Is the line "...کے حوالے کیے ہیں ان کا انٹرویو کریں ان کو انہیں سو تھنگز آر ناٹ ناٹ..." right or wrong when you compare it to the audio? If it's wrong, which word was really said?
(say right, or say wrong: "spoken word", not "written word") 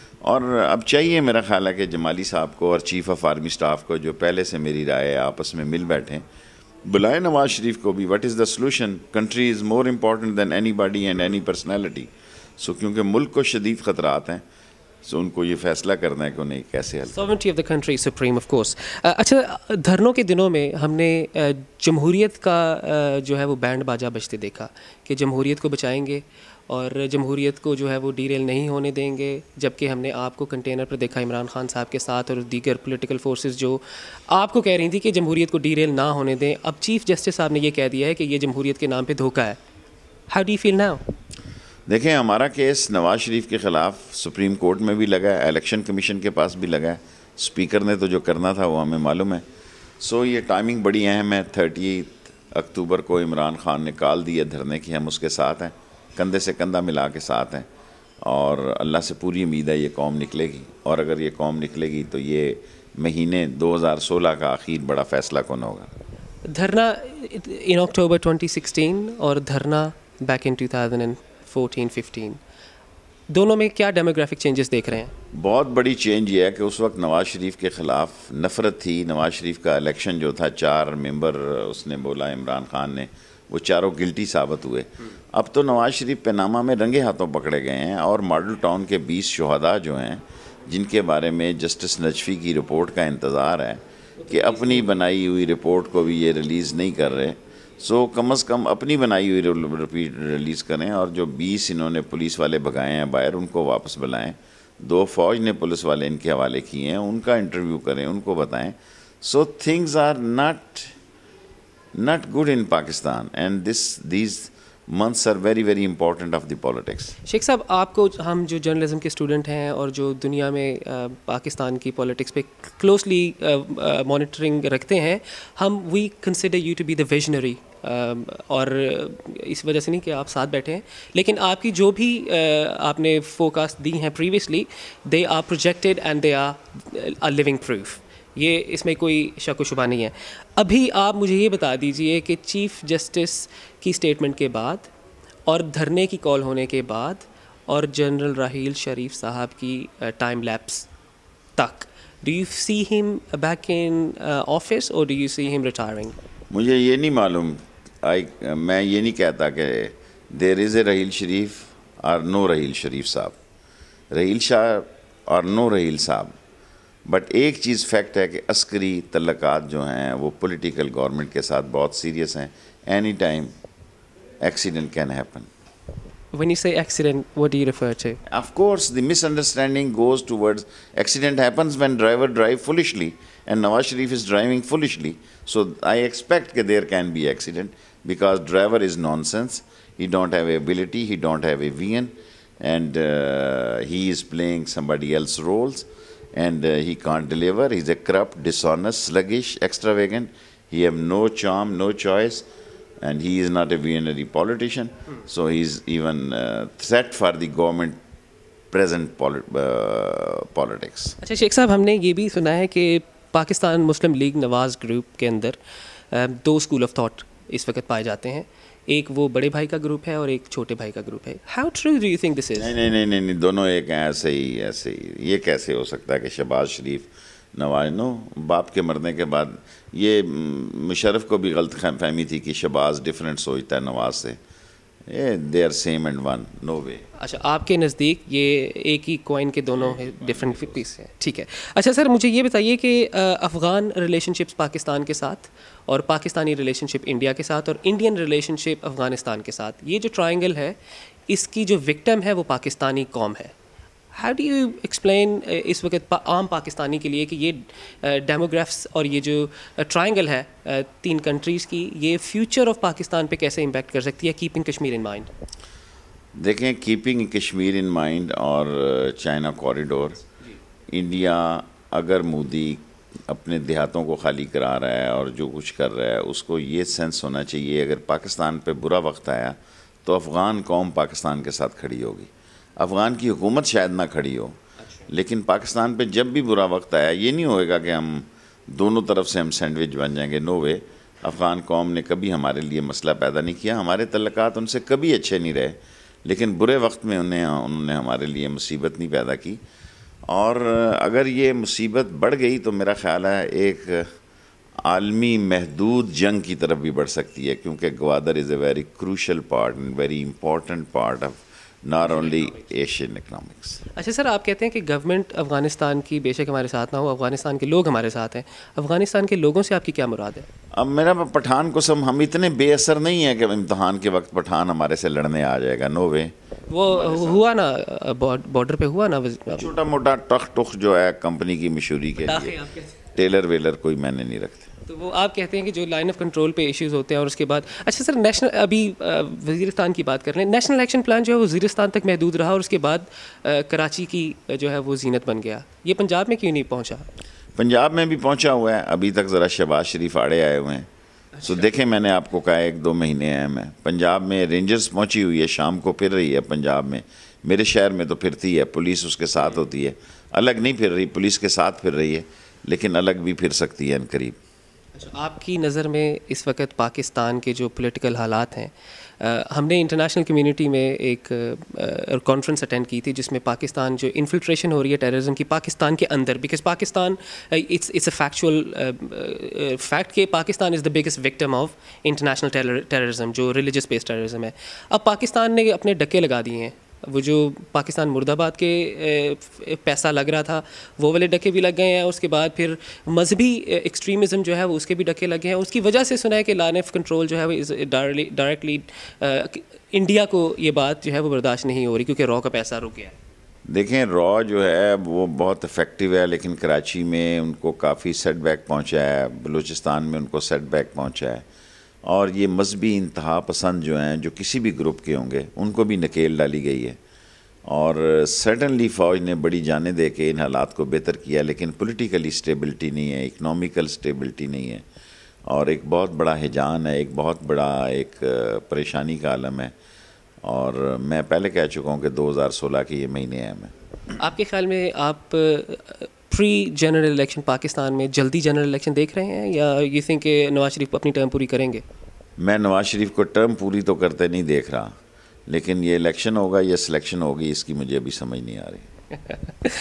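wrong: "بتائیں", not "انہیں".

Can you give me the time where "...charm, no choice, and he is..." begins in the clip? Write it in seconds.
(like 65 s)
201 s.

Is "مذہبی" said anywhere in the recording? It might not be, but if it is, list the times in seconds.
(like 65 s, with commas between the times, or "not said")
393 s, 412 s.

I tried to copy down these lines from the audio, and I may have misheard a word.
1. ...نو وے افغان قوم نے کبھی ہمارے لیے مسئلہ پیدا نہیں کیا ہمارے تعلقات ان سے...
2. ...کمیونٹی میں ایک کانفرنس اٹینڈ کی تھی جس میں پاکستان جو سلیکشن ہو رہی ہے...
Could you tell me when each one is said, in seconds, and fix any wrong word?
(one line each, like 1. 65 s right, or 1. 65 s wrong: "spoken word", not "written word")
1. 290 s right
2. 370 s wrong: "انفلٹریشن", not "سلیکشن".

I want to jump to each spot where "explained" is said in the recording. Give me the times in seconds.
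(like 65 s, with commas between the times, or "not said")
not said.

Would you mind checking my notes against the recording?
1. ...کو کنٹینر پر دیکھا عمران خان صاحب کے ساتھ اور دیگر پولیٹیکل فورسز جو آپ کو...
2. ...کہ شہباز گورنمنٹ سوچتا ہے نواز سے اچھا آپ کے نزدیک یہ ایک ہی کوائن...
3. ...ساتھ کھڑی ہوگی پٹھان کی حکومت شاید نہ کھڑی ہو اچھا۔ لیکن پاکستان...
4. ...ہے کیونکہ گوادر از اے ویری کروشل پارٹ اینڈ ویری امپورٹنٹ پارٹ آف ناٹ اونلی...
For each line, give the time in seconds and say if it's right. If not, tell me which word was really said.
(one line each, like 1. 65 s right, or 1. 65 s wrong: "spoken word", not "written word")
1. 30 s right
2. 232 s wrong: "ڈفرینٹ", not "گورنمنٹ"
3. 281 s wrong: "افغان", not "پٹھان"
4. 307 s right.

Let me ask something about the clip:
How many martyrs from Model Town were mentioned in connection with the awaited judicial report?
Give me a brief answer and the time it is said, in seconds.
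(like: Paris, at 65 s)
20, at 89 s.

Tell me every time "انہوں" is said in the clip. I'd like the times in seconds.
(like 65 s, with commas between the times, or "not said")
101 s, 297 s.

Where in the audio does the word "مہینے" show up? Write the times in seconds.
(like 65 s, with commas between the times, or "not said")
63 s, 352 s, 433 s.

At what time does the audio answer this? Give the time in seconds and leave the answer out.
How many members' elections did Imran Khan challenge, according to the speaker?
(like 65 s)
80 s.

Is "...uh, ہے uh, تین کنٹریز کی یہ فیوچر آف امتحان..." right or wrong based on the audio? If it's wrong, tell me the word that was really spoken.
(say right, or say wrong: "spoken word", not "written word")
wrong: "پاکستان", not "امتحان".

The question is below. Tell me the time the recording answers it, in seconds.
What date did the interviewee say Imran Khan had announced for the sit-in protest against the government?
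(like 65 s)
51 s.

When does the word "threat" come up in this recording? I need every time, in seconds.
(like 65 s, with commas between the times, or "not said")
206 s.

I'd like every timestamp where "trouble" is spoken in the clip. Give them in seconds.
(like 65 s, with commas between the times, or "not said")
not said.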